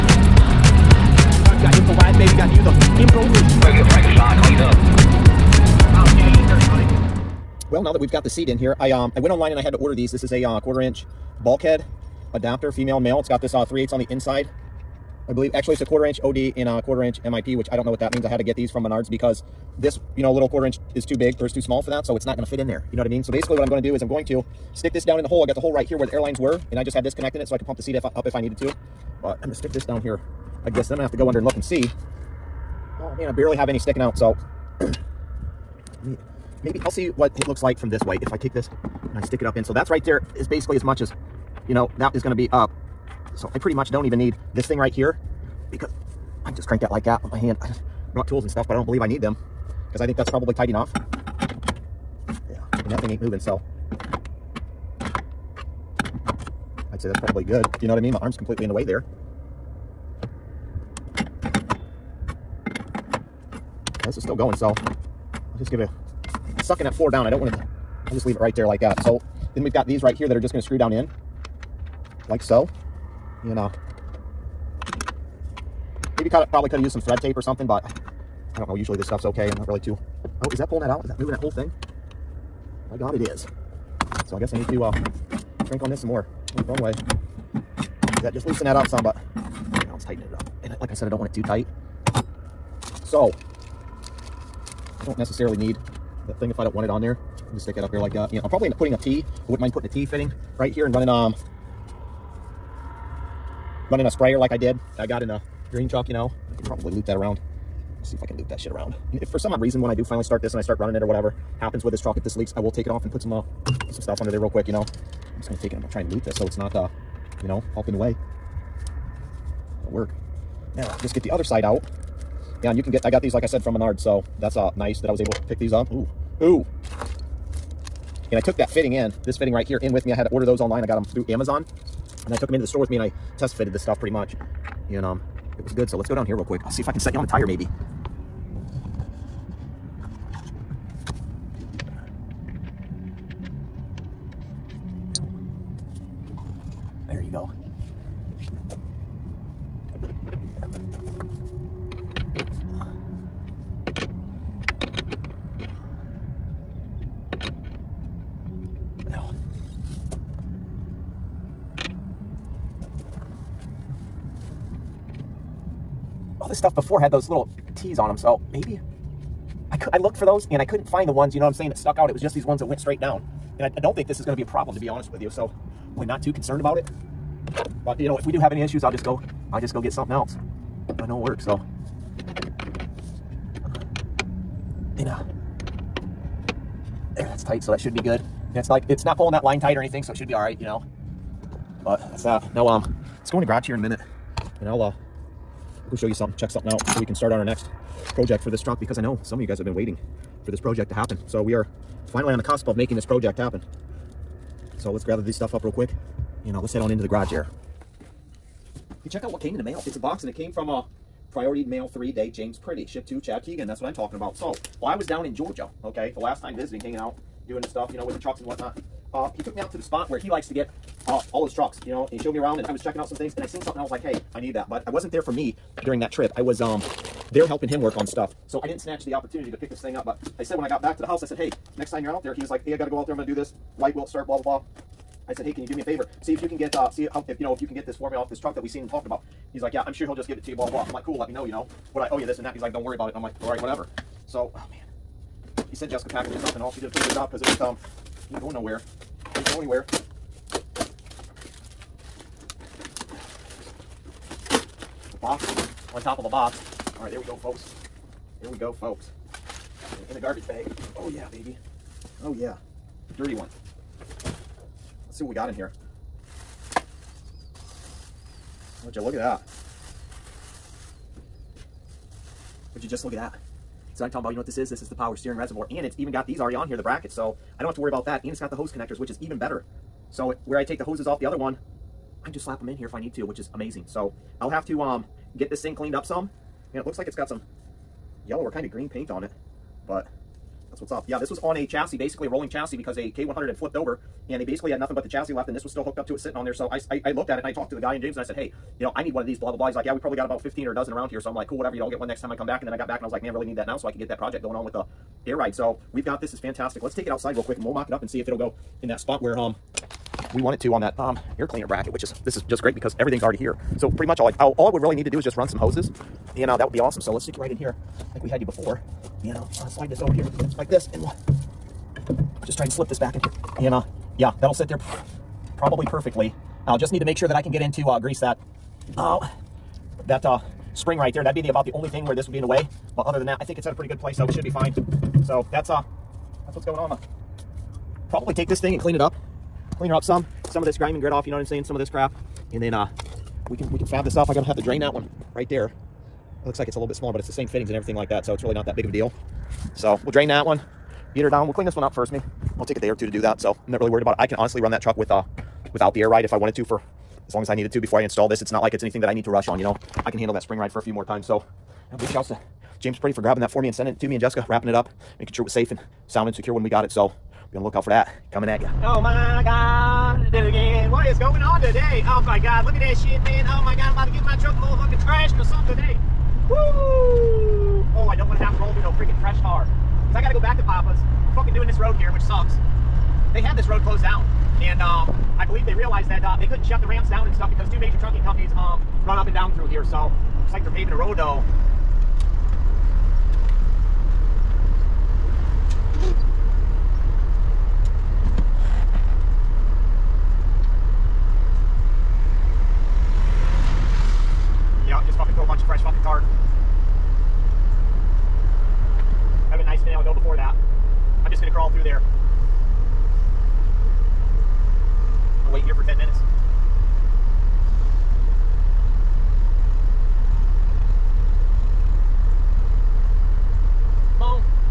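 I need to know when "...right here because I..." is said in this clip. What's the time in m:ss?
0:44.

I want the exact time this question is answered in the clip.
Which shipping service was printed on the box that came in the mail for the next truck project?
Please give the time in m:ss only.
3:31.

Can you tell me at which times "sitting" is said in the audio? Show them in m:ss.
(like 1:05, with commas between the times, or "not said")
4:56.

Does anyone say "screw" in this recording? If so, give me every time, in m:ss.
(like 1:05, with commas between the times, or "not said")
1:10.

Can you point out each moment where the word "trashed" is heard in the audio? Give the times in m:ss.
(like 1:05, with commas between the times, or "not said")
6:15.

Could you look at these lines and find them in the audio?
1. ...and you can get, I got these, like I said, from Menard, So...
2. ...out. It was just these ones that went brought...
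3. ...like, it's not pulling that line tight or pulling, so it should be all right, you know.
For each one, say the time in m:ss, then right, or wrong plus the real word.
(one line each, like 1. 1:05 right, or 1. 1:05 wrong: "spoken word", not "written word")
1. 2:02 right
2. 2:51 wrong: "straight", not "brought"
3. 3:08 wrong: "anything", not "pulling".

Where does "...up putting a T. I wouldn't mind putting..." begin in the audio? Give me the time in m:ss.
1:38.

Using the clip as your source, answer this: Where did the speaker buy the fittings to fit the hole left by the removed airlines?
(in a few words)
Menards.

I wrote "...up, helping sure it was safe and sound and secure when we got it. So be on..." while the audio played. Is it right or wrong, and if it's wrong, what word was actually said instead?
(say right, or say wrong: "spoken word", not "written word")
wrong: "making", not "helping".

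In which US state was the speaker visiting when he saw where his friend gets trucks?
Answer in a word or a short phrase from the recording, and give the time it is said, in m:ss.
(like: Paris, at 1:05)
Georgia, at 3:35.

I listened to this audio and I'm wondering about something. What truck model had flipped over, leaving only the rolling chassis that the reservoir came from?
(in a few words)
K100.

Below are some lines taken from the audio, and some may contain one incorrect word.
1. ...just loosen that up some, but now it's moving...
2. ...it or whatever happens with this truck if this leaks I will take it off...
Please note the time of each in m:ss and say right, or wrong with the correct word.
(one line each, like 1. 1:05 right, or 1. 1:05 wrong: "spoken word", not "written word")
1. 1:28 wrong: "tightening", not "moving"
2. 1:50 right.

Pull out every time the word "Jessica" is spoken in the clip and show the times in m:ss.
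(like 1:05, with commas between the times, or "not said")
4:05, 6:04.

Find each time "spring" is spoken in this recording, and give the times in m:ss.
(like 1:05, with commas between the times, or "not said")
5:30, 6:00.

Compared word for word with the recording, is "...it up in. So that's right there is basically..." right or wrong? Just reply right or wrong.
right.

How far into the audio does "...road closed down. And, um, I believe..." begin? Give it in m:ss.
6:23.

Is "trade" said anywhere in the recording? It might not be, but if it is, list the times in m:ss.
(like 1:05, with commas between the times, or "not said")
not said.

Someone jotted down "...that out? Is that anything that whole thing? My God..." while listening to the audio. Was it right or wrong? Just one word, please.
wrong.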